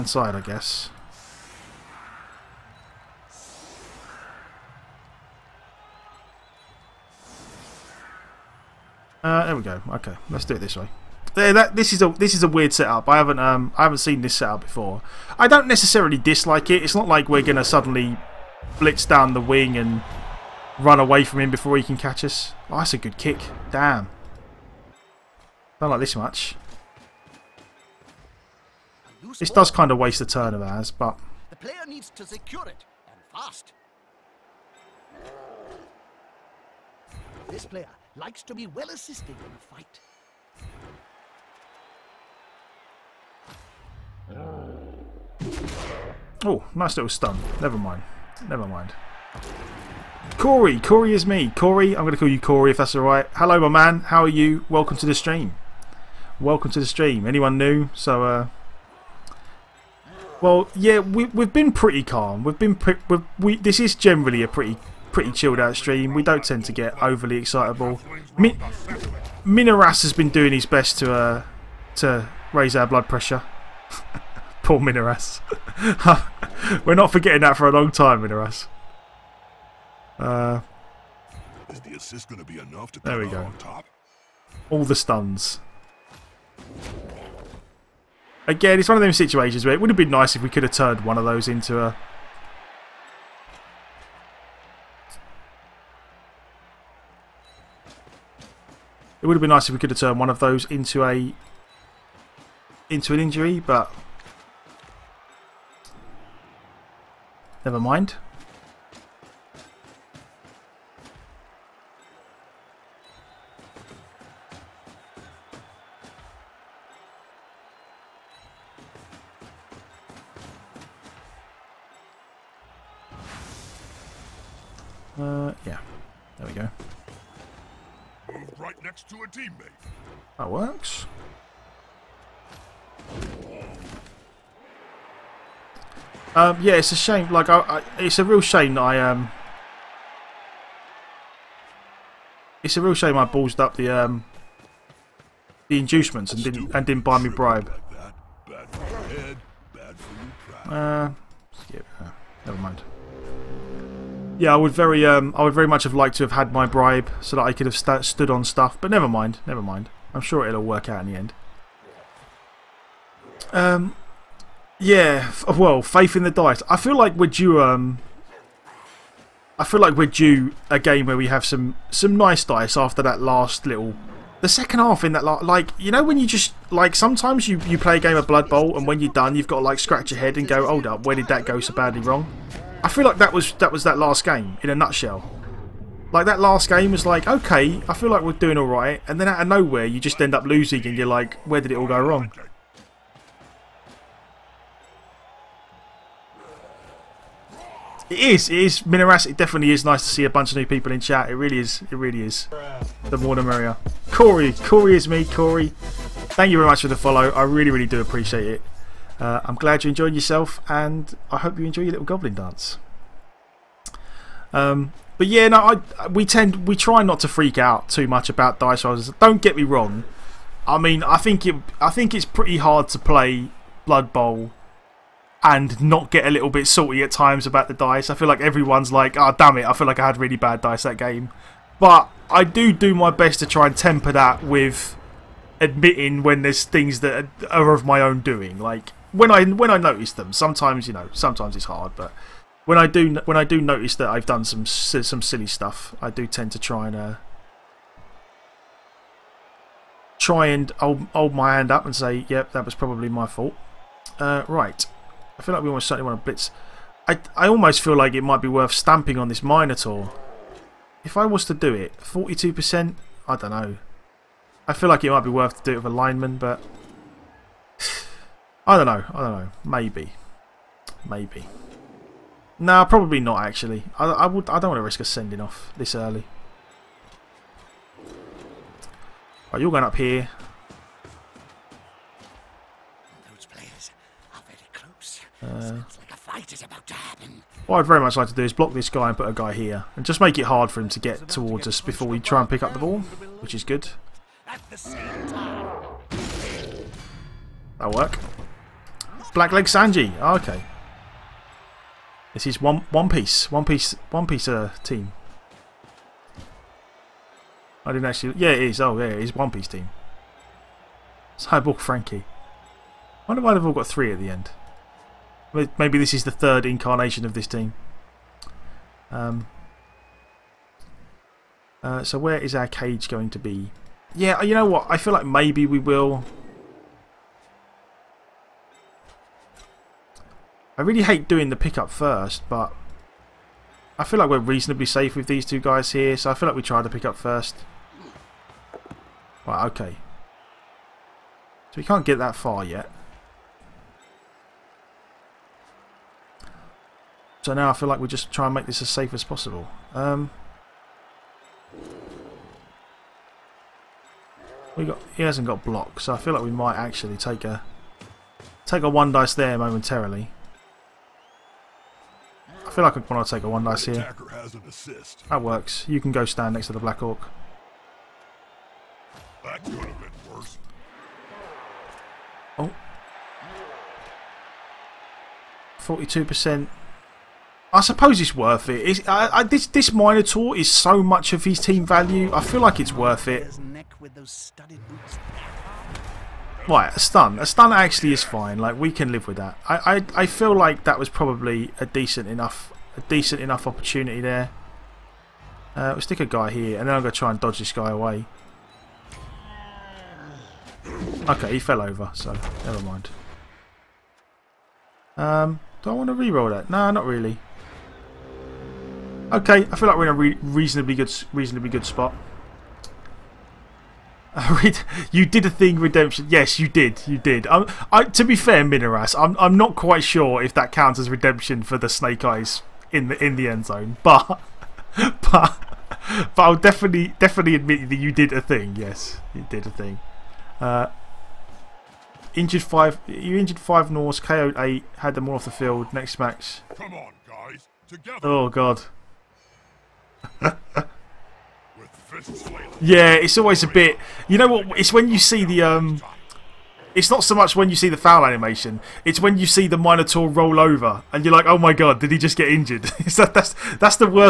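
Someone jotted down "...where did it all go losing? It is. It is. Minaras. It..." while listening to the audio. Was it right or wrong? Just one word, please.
wrong.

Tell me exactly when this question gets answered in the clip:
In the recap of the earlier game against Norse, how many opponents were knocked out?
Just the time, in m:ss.
7:14.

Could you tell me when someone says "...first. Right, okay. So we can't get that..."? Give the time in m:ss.
5:37.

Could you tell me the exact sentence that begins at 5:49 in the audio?
Um, we got he hasn't got block, so I feel like we might actually take a take a one dice there momentarily.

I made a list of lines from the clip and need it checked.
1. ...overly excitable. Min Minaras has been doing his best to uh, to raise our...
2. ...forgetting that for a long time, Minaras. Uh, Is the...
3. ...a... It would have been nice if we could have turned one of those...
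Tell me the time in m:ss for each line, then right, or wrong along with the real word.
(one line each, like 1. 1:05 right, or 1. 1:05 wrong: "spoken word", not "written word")
1. 1:07 right
2. 1:17 right
3. 1:31 right.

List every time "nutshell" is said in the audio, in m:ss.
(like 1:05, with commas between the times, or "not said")
3:04.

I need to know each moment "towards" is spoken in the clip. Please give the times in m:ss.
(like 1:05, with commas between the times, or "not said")
4:51.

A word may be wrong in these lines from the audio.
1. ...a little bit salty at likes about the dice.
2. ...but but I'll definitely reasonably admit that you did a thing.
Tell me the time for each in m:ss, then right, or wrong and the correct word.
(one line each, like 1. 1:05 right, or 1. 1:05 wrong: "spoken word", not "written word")
1. 3:46 wrong: "times", not "likes"
2. 7:04 wrong: "definitely", not "reasonably".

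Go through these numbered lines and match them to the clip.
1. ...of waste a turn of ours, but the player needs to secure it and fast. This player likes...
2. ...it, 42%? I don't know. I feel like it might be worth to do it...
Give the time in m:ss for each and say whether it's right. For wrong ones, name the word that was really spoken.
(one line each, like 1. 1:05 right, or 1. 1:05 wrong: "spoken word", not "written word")
1. 0:29 right
2. 4:21 right.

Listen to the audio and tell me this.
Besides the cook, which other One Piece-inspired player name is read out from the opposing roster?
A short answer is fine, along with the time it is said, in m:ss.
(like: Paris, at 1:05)
Cyborg Frankie, at 5:11.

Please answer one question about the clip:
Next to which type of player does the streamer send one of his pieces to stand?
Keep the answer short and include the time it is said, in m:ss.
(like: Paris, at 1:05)
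Black Orc, at 6:06.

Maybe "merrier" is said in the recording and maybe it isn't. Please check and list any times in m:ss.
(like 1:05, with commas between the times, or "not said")
3:23.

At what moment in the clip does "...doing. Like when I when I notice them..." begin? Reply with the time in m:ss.
3:58.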